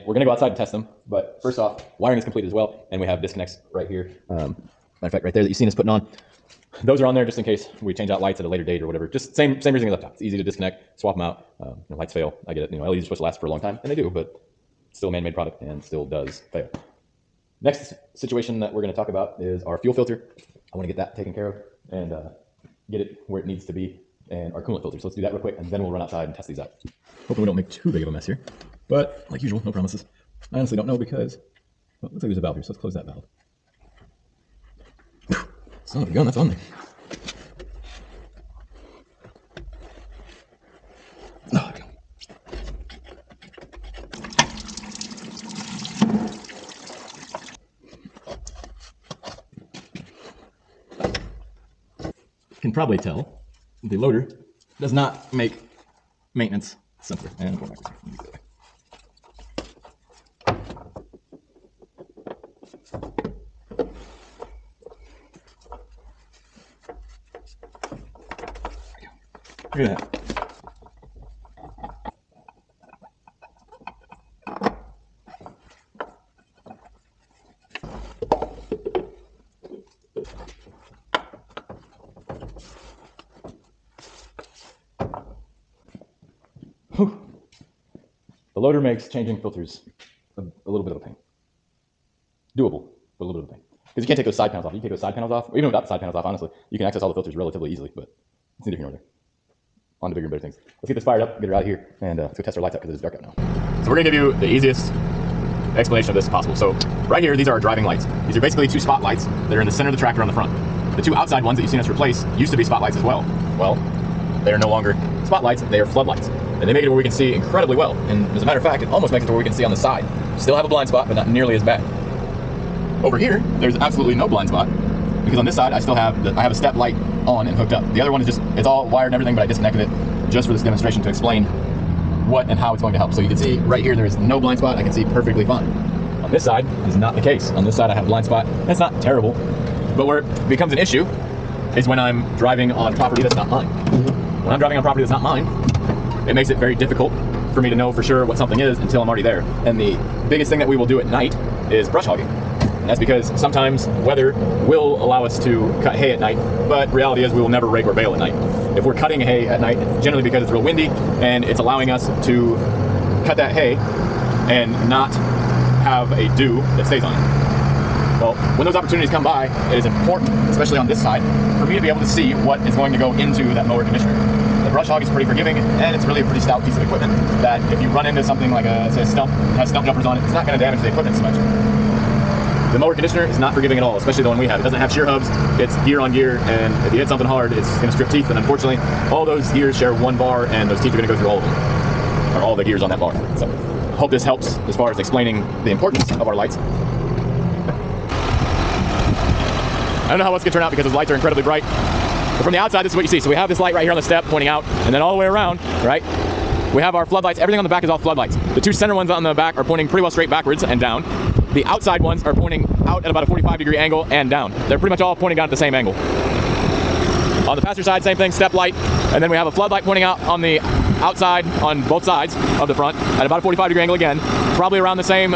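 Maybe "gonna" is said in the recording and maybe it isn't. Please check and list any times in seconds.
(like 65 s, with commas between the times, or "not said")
0 s, 103 s.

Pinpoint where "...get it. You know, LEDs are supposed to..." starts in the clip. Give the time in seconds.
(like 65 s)
12 s.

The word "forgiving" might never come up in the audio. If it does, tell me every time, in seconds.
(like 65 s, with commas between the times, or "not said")
175 s, 183 s.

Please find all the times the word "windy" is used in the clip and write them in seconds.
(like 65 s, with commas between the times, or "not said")
160 s.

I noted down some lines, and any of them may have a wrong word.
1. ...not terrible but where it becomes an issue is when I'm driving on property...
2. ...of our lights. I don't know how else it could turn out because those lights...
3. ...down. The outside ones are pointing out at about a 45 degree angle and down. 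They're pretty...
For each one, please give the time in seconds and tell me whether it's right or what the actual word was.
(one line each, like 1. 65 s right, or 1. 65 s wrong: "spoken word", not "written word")
1. 138 s right
2. 196 s right
3. 210 s right.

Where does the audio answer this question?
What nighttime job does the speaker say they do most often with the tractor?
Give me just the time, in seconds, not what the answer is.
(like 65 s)
151 s.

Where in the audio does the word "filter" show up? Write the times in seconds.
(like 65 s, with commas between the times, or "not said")
19 s, 24 s, 89 s, 97 s.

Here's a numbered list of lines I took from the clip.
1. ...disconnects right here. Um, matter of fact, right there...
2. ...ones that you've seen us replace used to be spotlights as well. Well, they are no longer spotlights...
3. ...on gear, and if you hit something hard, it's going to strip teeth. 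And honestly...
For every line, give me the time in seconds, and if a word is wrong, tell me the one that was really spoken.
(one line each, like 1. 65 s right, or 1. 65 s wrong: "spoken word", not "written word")
1. 3 s right
2. 111 s right
3. 185 s wrong: "unfortunately", not "honestly".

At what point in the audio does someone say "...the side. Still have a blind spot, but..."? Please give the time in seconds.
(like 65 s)
119 s.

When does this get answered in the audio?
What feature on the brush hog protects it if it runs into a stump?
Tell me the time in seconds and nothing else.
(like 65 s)
179 s.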